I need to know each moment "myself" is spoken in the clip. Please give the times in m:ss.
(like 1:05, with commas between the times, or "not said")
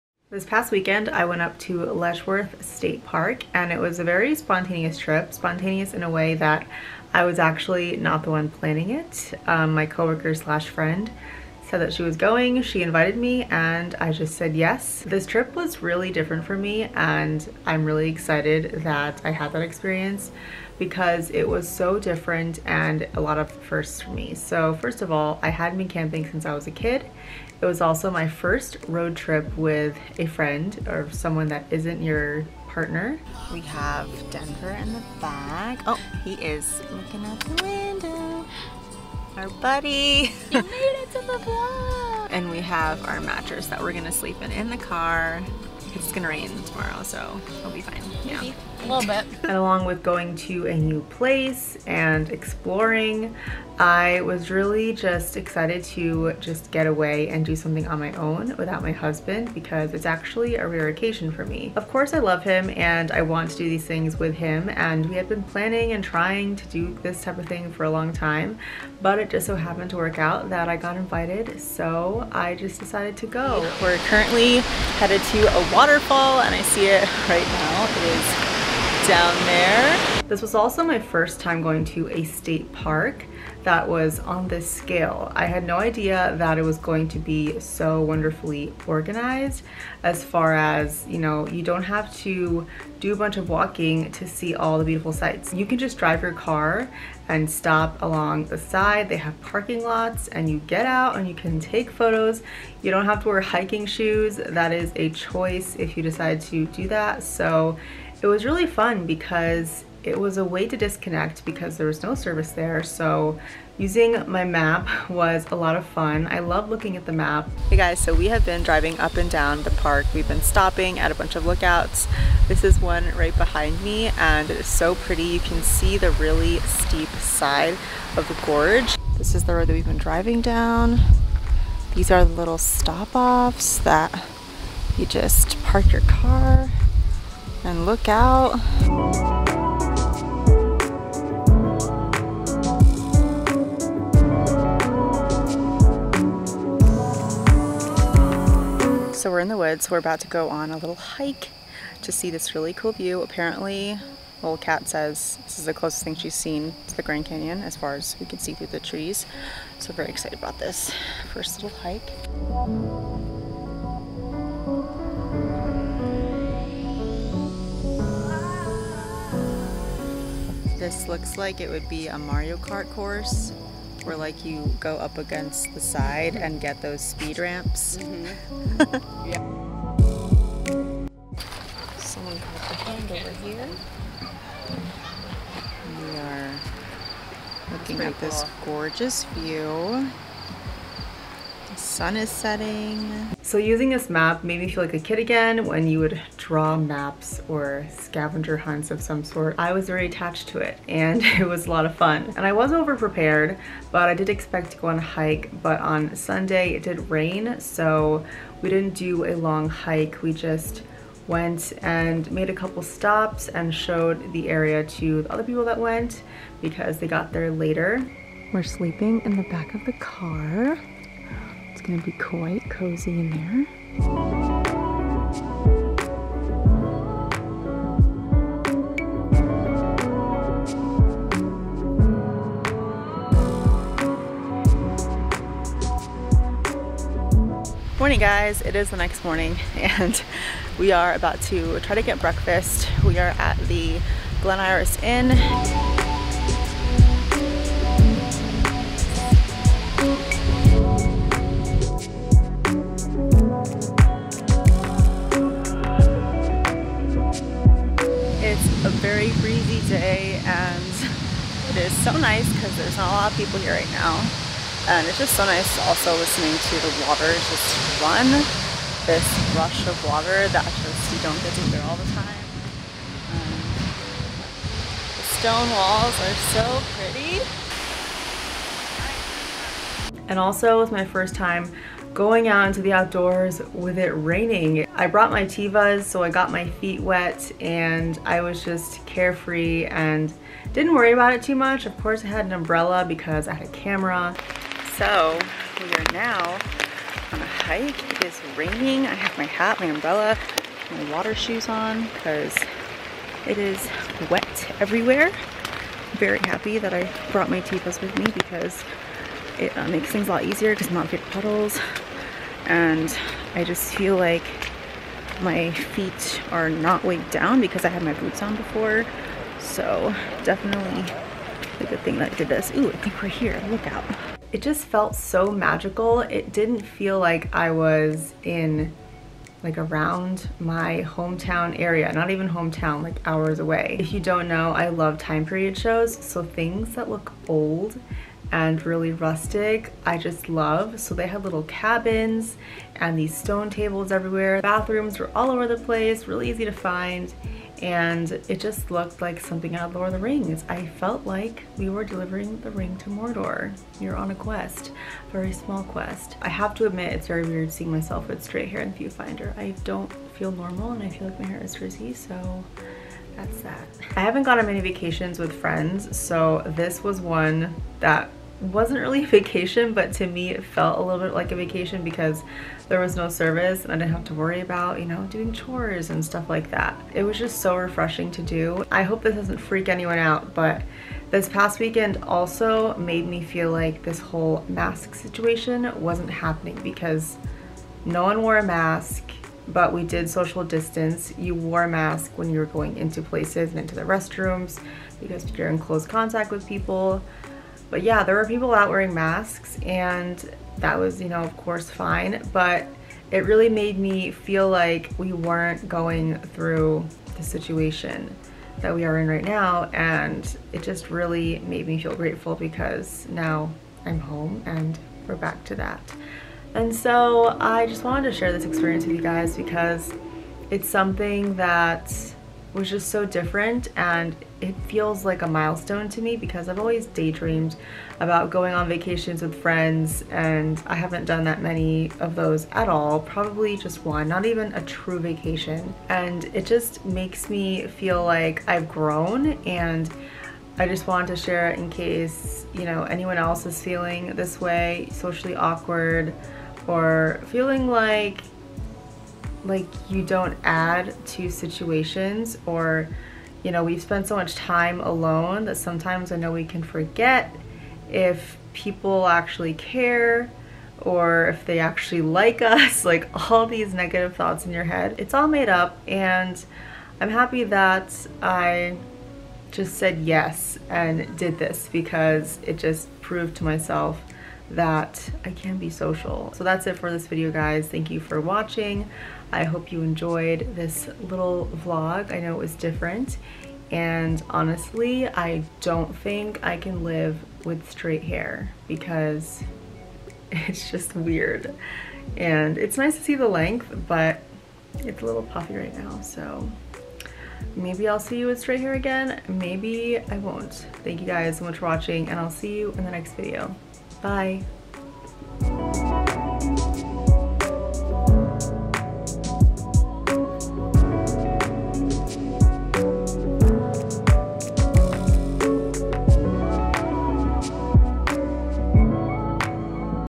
5:57, 7:53.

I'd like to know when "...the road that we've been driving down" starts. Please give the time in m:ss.
2:09.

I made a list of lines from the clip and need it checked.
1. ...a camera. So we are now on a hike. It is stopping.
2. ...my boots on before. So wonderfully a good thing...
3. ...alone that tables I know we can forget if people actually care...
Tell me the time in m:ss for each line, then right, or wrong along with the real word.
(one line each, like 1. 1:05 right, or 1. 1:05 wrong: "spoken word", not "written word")
1. 4:53 wrong: "raining", not "stopping"
2. 5:18 wrong: "definitely", not "wonderfully"
3. 7:35 wrong: "sometimes", not "tables".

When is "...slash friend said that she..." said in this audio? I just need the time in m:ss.
0:10.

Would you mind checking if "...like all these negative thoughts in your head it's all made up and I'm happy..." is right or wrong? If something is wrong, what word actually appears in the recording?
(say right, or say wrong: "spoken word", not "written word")
right.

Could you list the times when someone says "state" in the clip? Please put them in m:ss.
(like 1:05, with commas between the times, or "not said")
0:02, 1:22.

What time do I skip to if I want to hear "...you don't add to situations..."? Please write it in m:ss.
7:30.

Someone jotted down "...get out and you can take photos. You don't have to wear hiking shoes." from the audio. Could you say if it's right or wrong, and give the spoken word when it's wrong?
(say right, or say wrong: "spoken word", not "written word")
right.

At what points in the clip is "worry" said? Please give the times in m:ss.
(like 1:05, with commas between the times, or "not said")
4:50, 6:14.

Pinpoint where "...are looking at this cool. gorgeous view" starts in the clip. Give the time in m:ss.
3:06.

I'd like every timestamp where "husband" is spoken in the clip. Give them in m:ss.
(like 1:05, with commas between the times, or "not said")
0:58.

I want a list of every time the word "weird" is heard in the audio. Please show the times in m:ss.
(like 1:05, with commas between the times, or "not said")
5:57, 8:11.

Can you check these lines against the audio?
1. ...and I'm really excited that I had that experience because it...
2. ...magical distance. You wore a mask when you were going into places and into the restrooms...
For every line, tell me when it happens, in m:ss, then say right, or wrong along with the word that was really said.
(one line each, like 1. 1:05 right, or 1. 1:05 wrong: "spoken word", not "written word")
1. 0:16 right
2. 6:30 wrong: "social", not "magical".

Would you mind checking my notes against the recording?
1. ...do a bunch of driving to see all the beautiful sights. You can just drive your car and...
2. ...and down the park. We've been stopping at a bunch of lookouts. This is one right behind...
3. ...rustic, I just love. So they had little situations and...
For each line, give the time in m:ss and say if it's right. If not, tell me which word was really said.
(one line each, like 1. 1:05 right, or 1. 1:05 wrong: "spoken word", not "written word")
1. 1:32 wrong: "walking", not "driving"
2. 1:59 right
3. 5:39 wrong: "cabins", not "situations".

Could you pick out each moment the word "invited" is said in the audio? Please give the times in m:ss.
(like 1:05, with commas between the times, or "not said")
0:12, 1:10.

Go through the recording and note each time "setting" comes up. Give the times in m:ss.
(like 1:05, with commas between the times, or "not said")
3:12.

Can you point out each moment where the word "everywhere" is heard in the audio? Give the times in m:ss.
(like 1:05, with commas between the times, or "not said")
5:04, 5:44.